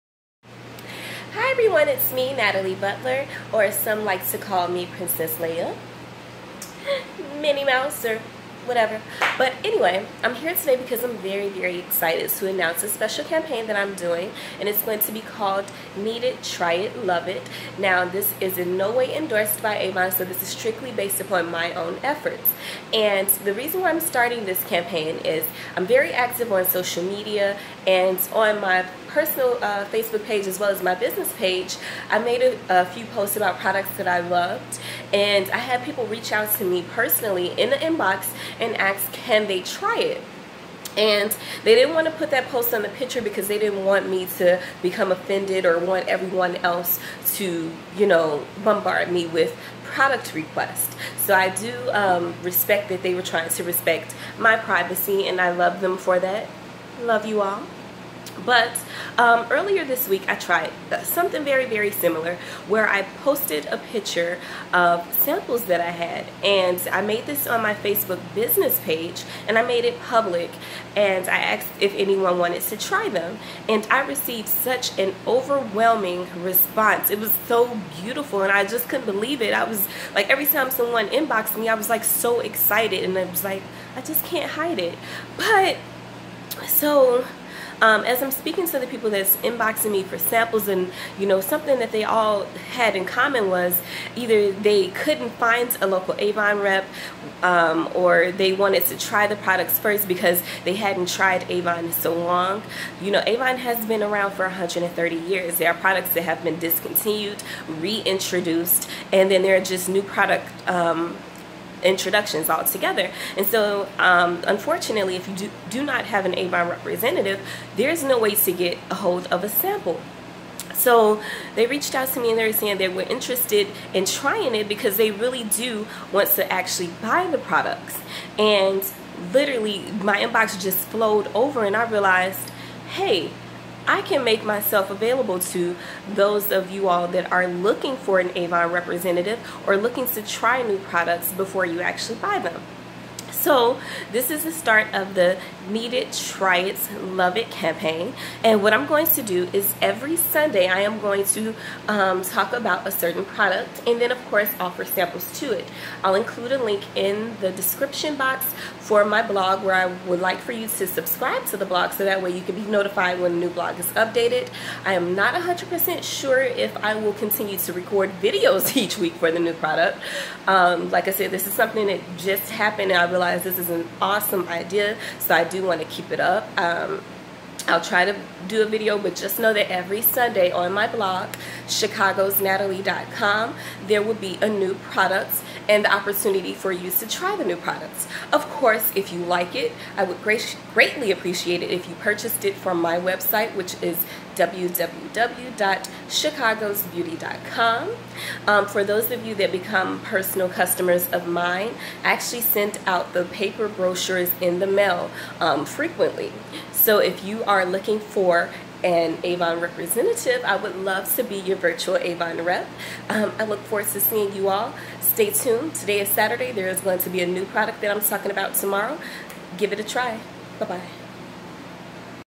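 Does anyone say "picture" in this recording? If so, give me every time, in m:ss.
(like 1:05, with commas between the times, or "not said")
0:42, 1:03.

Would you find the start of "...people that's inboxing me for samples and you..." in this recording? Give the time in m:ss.
1:28.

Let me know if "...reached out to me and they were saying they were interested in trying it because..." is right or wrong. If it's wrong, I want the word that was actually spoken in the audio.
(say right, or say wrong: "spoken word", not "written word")
right.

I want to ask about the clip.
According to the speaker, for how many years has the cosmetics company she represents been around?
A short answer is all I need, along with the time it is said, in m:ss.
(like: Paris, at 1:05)
130 years, at 1:44.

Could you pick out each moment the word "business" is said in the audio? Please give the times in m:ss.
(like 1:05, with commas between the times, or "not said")
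0:30, 1:08.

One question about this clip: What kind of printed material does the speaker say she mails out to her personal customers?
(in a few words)
paper brochures.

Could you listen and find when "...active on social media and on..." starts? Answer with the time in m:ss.
0:26.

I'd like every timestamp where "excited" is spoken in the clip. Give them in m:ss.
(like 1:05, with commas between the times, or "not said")
0:11, 1:22.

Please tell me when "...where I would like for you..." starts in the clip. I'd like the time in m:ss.
2:39.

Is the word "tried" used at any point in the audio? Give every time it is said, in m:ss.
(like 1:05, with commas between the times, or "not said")
1:00, 1:41.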